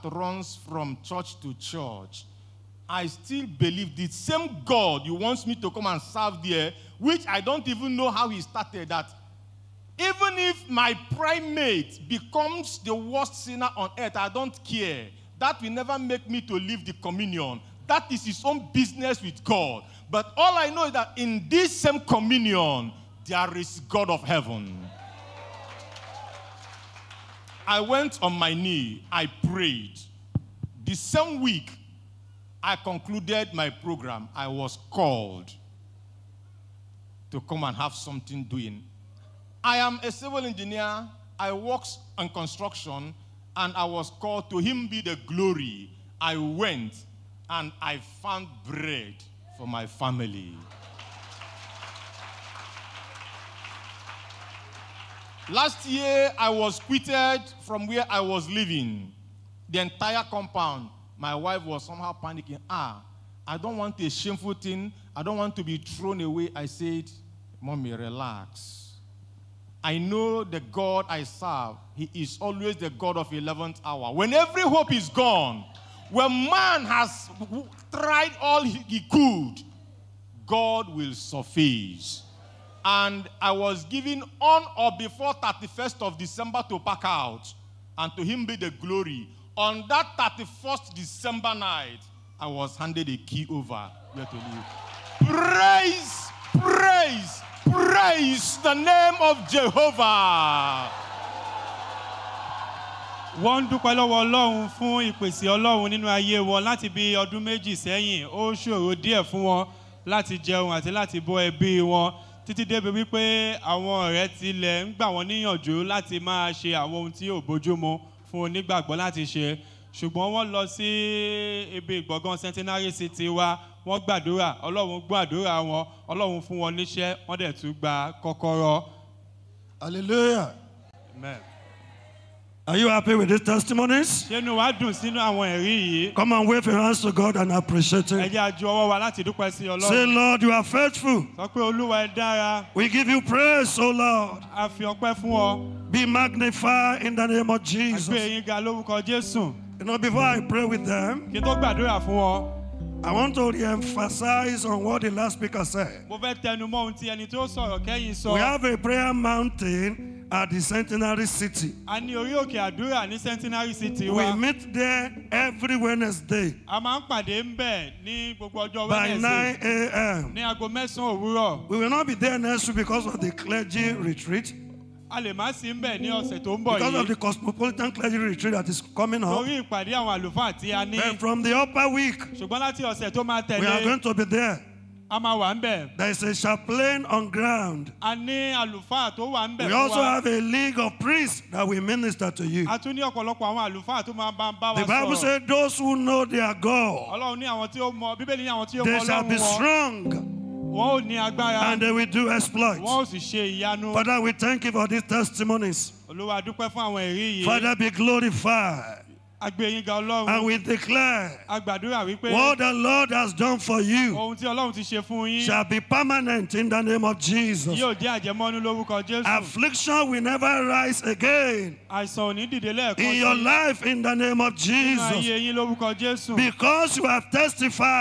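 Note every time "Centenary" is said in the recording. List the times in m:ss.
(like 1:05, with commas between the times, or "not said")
2:02, 2:40.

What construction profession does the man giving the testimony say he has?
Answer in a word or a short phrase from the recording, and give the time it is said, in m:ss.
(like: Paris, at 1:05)
civil engineer, at 0:40.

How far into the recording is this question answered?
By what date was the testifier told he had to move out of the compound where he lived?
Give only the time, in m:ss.
1:25.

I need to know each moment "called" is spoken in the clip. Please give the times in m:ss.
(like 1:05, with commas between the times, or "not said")
0:34, 0:44.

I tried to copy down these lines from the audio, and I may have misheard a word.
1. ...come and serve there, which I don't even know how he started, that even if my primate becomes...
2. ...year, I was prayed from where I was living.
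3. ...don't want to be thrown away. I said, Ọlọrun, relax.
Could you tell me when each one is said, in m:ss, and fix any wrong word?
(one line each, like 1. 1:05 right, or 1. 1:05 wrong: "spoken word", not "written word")
1. 0:05 right
2. 0:55 wrong: "quitted", not "prayed"
3. 1:05 wrong: "Mommy", not "Ọlọrun".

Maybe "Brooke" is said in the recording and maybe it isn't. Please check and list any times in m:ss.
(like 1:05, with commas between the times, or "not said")
not said.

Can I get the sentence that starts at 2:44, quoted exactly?
We meet there every Wednesday by 9 a.m.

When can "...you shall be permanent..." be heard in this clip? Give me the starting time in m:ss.
3:33.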